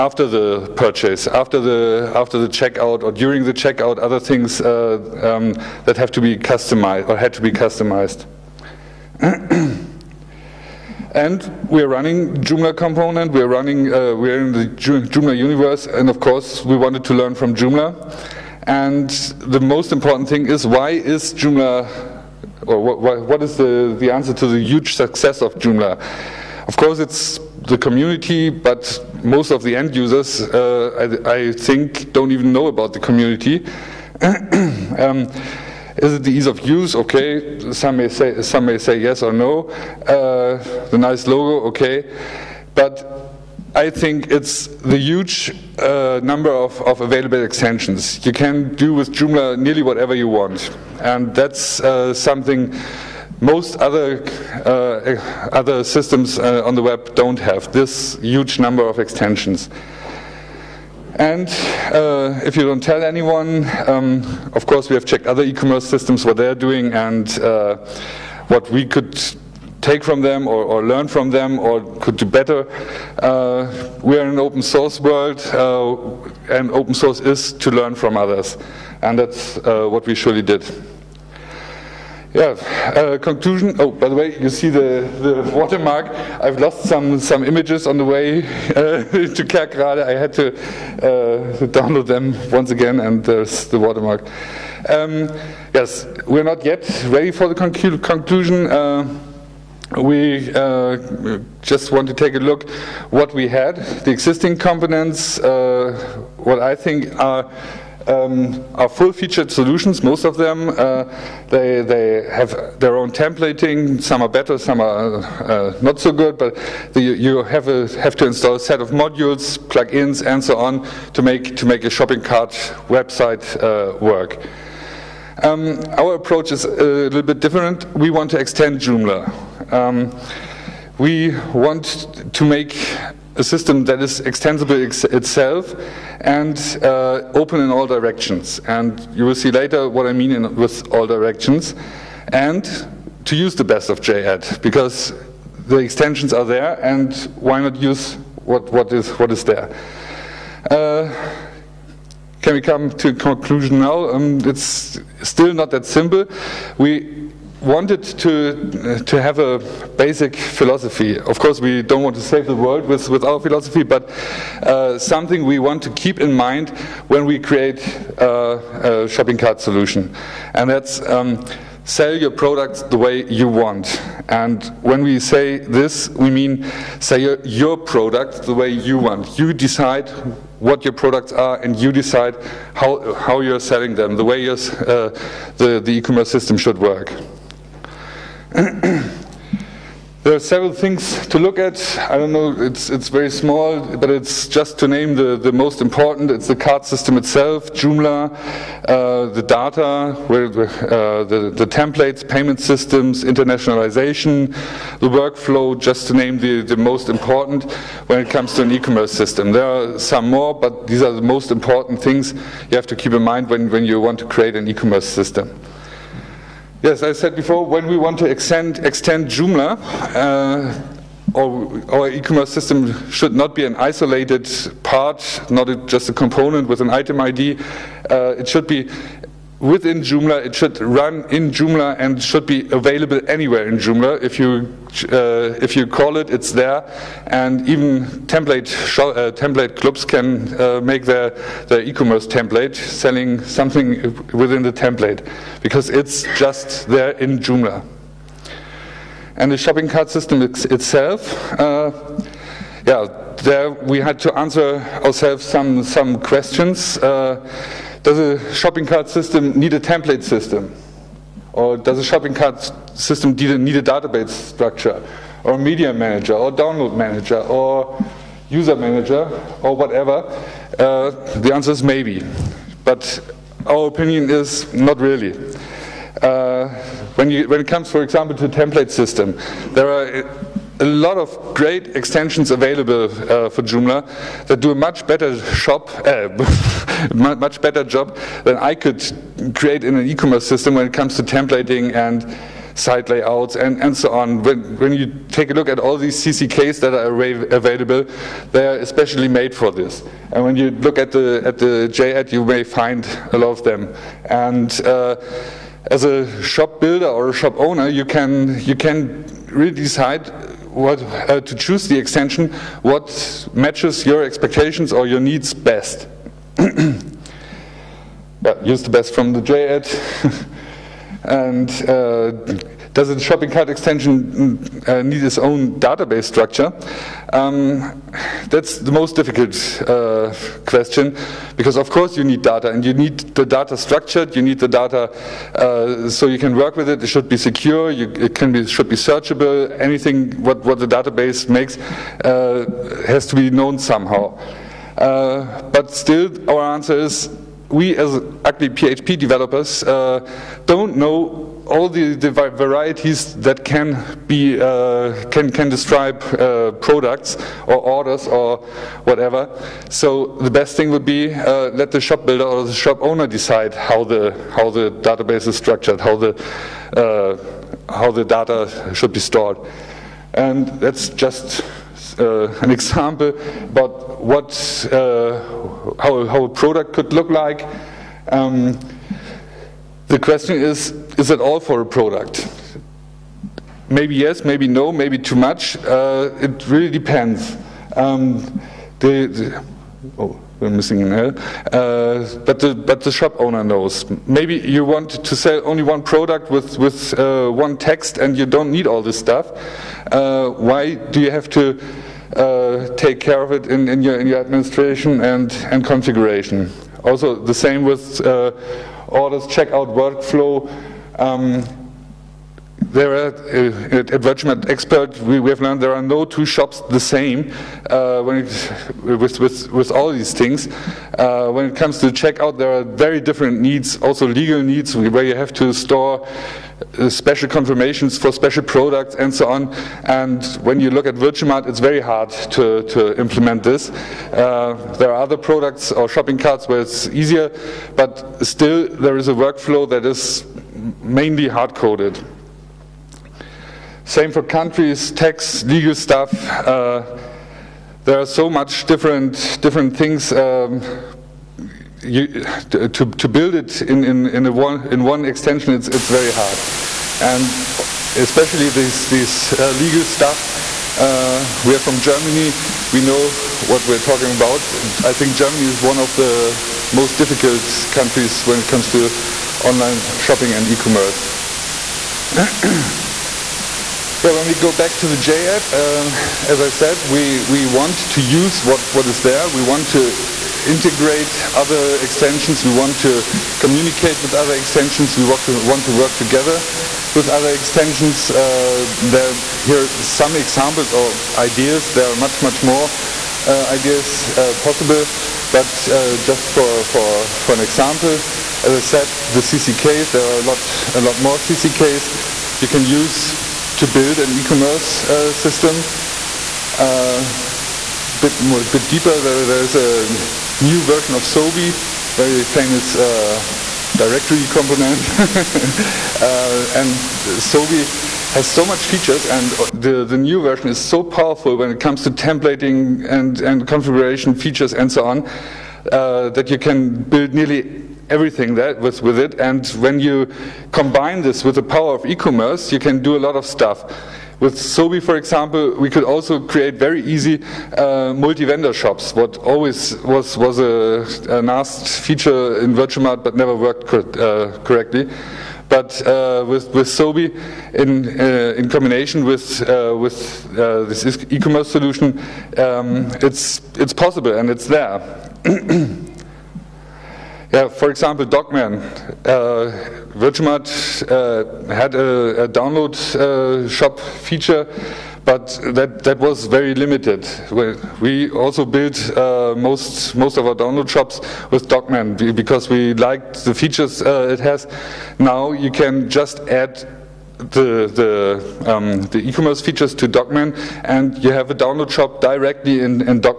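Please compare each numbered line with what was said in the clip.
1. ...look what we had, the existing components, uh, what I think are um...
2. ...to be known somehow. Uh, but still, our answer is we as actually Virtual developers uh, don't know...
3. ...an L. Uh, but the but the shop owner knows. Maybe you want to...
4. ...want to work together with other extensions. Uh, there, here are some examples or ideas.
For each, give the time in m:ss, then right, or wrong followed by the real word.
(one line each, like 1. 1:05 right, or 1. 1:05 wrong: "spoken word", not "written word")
1. 1:42 right
2. 5:43 wrong: "PHP", not "Virtual"
3. 6:31 right
4. 8:05 right.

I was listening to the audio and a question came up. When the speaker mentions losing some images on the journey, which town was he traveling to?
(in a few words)
Kerkrade.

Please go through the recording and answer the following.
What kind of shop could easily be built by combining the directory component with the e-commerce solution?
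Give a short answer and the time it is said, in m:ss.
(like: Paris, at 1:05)
multi-vendor shops, at 8:58.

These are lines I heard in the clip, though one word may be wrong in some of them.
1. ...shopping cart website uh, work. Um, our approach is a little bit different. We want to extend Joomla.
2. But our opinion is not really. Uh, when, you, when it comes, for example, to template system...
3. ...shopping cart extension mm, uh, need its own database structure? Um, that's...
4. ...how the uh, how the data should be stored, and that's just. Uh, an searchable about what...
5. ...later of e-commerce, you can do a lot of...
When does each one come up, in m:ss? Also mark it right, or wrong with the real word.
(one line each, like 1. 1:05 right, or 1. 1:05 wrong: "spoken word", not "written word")
1. 2:01 right
2. 4:32 right
3. 5:23 right
4. 6:06 wrong: "example", not "searchable"
5. 8:51 wrong: "power", not "later".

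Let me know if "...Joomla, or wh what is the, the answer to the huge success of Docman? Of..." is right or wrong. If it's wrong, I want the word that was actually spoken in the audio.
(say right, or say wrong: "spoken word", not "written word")
wrong: "Joomla", not "Docman".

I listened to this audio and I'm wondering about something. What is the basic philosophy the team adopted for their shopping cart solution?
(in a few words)
Sell your products the way you want.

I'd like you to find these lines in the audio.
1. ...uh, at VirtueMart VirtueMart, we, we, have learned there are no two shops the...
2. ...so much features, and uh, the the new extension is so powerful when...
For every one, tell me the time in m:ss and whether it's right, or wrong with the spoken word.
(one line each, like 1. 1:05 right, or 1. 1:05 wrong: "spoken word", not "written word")
1. 6:53 wrong: "Expert", not "VirtueMart"
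2. 8:38 wrong: "version", not "extension".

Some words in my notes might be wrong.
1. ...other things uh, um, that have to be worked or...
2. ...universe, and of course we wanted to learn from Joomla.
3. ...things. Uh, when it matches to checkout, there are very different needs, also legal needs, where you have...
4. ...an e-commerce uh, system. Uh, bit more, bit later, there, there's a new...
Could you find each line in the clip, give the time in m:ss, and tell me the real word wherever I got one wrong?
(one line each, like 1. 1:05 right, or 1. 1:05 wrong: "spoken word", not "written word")
1. 0:03 wrong: "customized", not "worked"
2. 0:15 right
3. 7:00 wrong: "comes", not "matches"
4. 8:24 wrong: "deeper", not "later".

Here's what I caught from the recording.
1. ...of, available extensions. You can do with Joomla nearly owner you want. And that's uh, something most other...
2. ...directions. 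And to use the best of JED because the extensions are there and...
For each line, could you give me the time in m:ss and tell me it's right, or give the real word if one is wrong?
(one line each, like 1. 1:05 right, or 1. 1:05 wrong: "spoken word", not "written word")
1. 0:46 wrong: "whatever", not "owner"
2. 2:21 right.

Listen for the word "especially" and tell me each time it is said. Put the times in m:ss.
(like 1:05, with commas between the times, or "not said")
4:58, 7:38.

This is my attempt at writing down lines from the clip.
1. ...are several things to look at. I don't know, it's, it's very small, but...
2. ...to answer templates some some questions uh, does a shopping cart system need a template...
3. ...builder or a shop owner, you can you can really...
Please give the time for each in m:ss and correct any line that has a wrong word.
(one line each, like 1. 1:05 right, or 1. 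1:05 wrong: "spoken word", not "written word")
1. 3:10 right
2. 4:14 wrong: "ourselves", not "templates"
3. 5:06 right.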